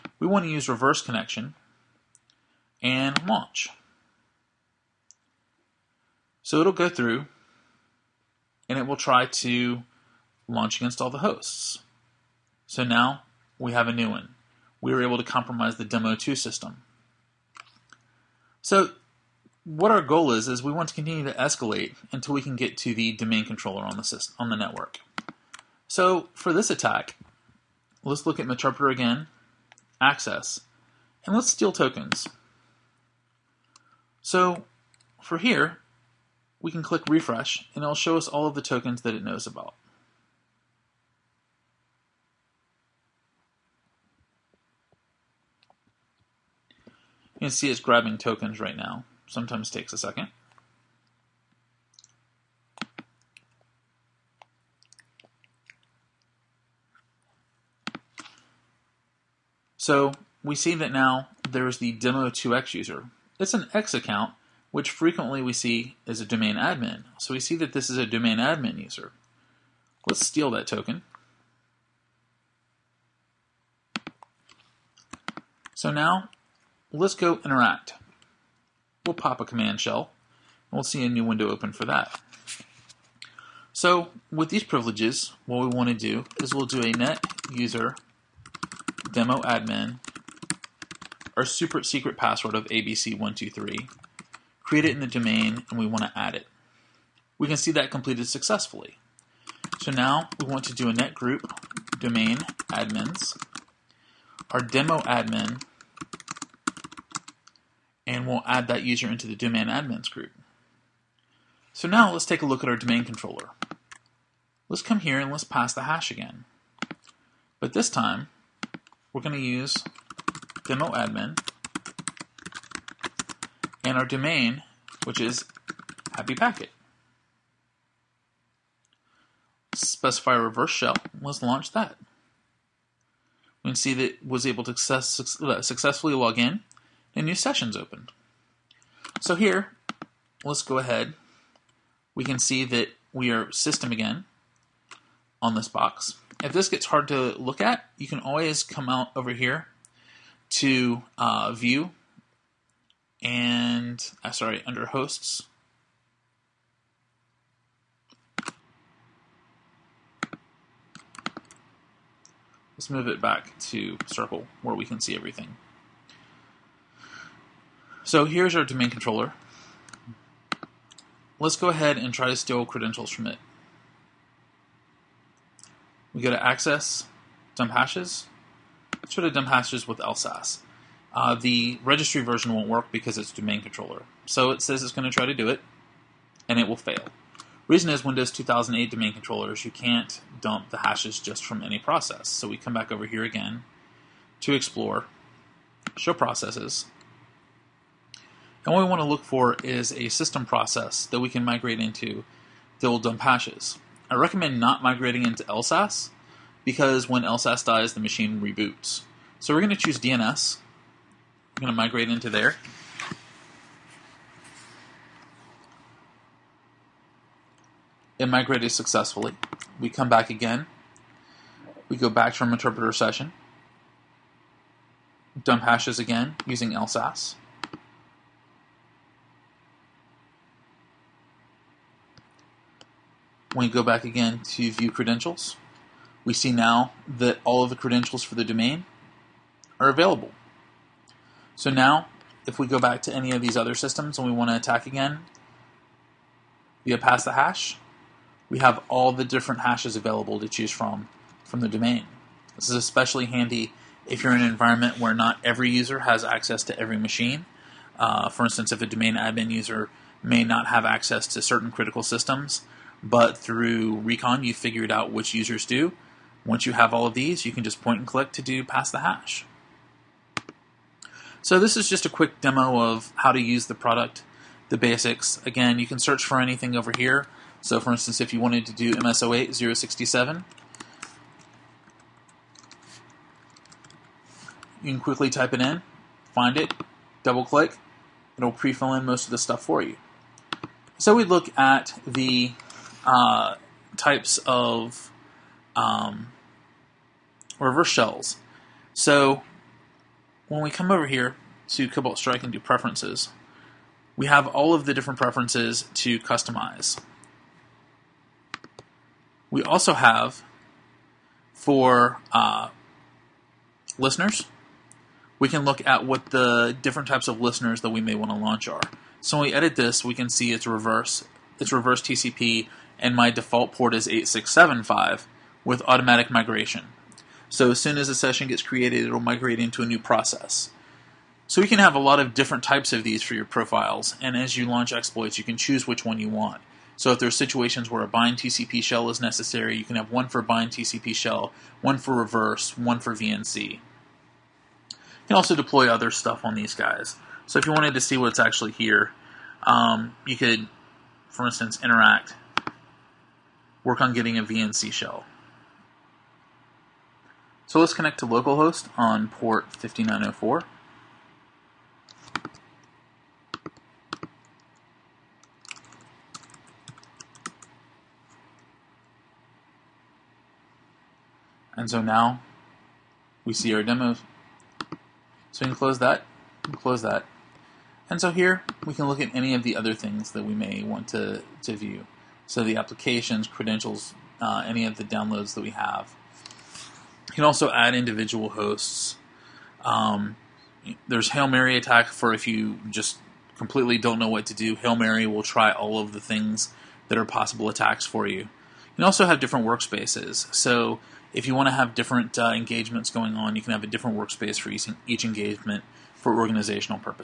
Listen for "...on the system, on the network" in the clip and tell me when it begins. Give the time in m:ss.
0:23.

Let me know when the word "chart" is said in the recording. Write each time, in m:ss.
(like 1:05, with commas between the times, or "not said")
not said.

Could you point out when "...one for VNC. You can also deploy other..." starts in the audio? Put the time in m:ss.
5:42.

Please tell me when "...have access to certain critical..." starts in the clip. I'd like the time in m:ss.
4:20.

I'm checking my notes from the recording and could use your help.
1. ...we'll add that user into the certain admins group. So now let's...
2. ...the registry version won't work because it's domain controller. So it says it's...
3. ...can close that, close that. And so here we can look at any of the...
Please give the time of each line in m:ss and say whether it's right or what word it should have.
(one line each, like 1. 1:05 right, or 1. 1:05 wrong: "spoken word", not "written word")
1. 1:48 wrong: "domain", not "certain"
2. 3:01 right
3. 6:15 right.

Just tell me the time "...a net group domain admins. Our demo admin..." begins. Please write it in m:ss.
1:40.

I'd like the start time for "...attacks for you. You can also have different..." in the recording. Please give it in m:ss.
6:37.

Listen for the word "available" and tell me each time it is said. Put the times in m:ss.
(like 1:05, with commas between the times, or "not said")
3:59, 4:09.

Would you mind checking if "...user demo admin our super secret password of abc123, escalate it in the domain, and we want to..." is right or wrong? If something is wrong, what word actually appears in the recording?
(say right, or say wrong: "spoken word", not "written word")
wrong: "create", not "escalate".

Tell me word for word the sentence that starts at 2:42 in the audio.
Let's move it back to circle where we can see everything.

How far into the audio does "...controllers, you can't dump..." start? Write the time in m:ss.
3:09.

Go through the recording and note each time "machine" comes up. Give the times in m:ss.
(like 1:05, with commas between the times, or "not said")
3:28, 4:16.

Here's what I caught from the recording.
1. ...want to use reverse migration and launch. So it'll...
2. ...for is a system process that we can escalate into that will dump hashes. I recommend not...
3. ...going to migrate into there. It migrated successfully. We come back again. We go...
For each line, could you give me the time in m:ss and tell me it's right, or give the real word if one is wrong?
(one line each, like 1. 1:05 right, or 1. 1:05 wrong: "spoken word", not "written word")
1. 0:00 wrong: "connection", not "migration"
2. 3:19 wrong: "migrate", not "escalate"
3. 3:31 right.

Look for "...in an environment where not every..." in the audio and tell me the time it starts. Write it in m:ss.
4:14.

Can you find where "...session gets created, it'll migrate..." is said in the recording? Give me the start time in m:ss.
5:28.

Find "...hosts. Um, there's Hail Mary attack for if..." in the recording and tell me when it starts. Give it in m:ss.
6:28.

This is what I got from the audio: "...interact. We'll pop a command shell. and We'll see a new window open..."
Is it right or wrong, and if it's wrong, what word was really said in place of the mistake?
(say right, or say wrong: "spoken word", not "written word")
right.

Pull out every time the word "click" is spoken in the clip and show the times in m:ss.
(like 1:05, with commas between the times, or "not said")
0:36, 4:28, 4:47.